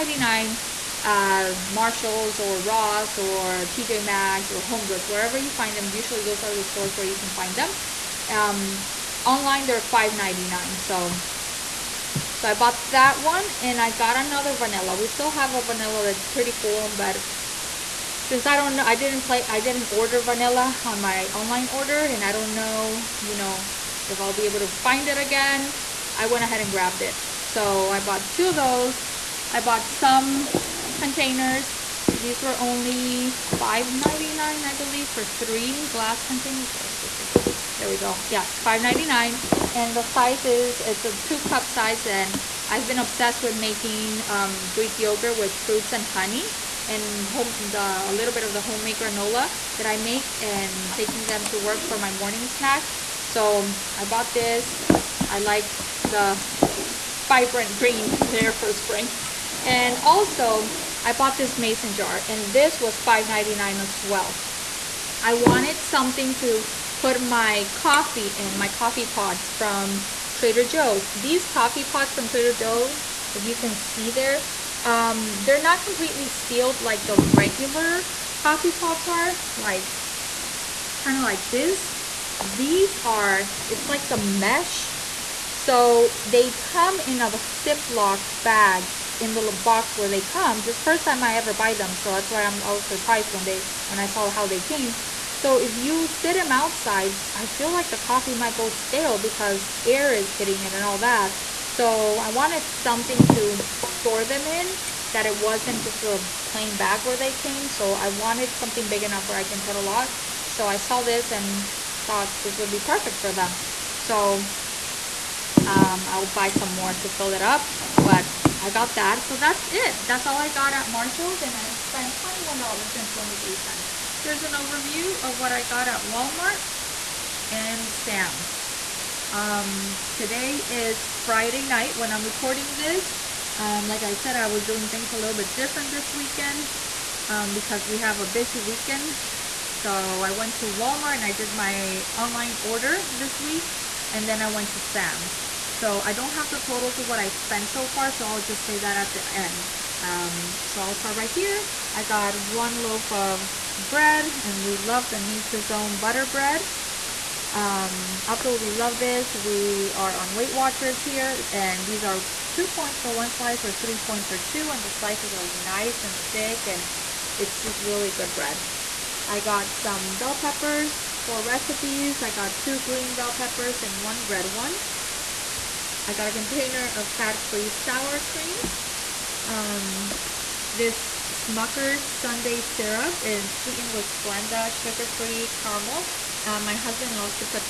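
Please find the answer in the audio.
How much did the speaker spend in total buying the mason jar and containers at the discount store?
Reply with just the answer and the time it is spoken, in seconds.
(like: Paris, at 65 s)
$21.23, at 122 s.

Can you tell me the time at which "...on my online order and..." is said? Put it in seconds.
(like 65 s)
20 s.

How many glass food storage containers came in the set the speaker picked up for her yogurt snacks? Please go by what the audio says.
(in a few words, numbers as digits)
3.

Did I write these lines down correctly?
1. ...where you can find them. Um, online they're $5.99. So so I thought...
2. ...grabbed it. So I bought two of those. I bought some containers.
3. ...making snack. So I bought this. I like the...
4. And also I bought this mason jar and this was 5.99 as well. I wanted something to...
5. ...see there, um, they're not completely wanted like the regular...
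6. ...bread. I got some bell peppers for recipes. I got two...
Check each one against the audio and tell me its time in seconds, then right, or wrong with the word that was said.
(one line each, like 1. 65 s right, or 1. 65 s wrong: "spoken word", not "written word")
1. 6 s wrong: "bought", not "thought"
2. 26 s right
3. 52 s wrong: "morning", not "making"
4. 59 s right
5. 73 s wrong: "sealed", not "wanted"
6. 168 s right.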